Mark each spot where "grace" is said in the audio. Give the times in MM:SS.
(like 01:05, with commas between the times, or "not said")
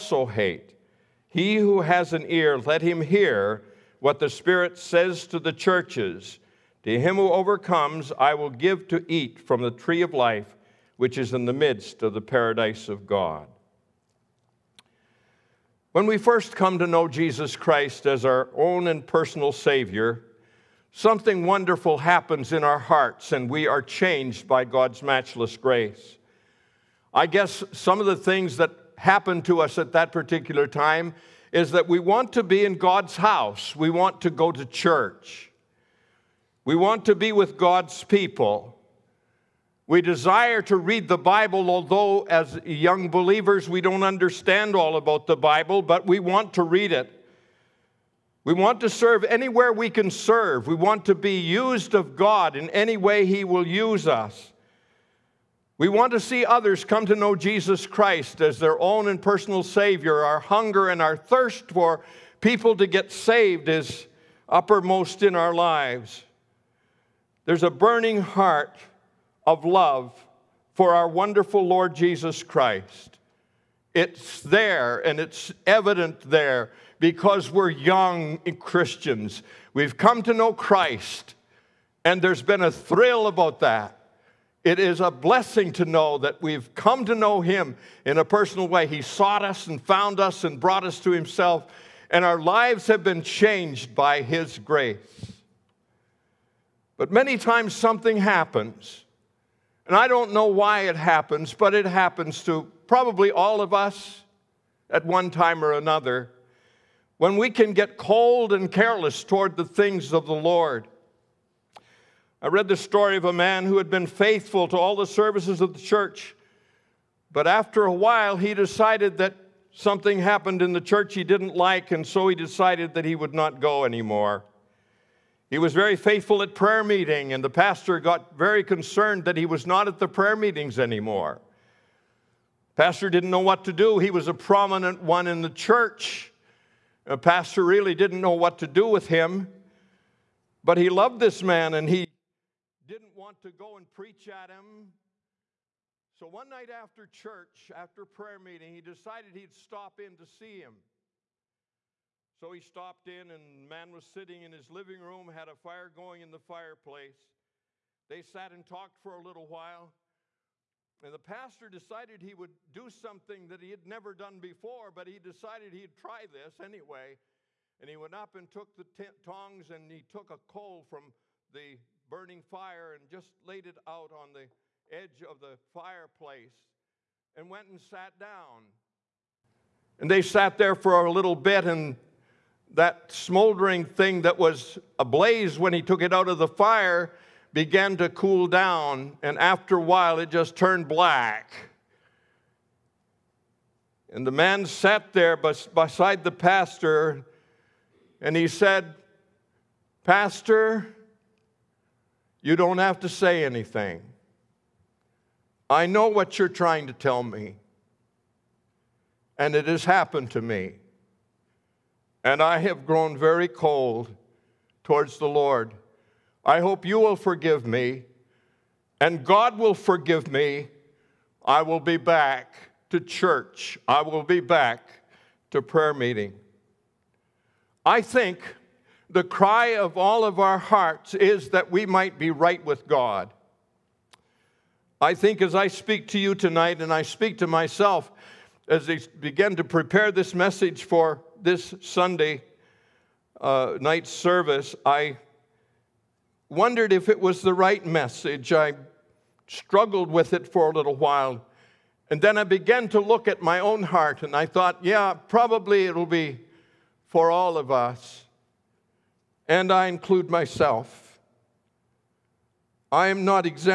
00:25, 01:34.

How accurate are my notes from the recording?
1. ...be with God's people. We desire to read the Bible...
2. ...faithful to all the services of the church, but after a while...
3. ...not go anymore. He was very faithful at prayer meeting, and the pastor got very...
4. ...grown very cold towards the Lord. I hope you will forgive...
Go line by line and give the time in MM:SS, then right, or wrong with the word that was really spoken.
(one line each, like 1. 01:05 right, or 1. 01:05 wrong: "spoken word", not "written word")
1. 00:37 right
2. 01:54 right
3. 02:03 right
4. 03:32 right.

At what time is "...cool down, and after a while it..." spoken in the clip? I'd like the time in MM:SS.
03:08.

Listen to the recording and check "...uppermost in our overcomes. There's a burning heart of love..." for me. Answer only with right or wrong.
wrong.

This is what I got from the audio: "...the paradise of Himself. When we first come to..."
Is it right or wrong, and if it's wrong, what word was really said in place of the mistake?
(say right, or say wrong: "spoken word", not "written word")
wrong: "God", not "Himself".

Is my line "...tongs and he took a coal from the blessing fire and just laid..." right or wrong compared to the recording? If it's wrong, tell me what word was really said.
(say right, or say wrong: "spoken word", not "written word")
wrong: "burning", not "blessing".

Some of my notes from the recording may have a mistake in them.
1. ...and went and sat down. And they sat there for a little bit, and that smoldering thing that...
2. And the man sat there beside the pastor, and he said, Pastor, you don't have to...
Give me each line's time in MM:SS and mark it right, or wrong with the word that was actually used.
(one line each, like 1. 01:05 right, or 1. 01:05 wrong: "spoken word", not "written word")
1. 02:57 right
2. 03:14 right.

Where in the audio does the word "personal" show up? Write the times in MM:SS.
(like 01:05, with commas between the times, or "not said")
00:19, 00:59, 01:28.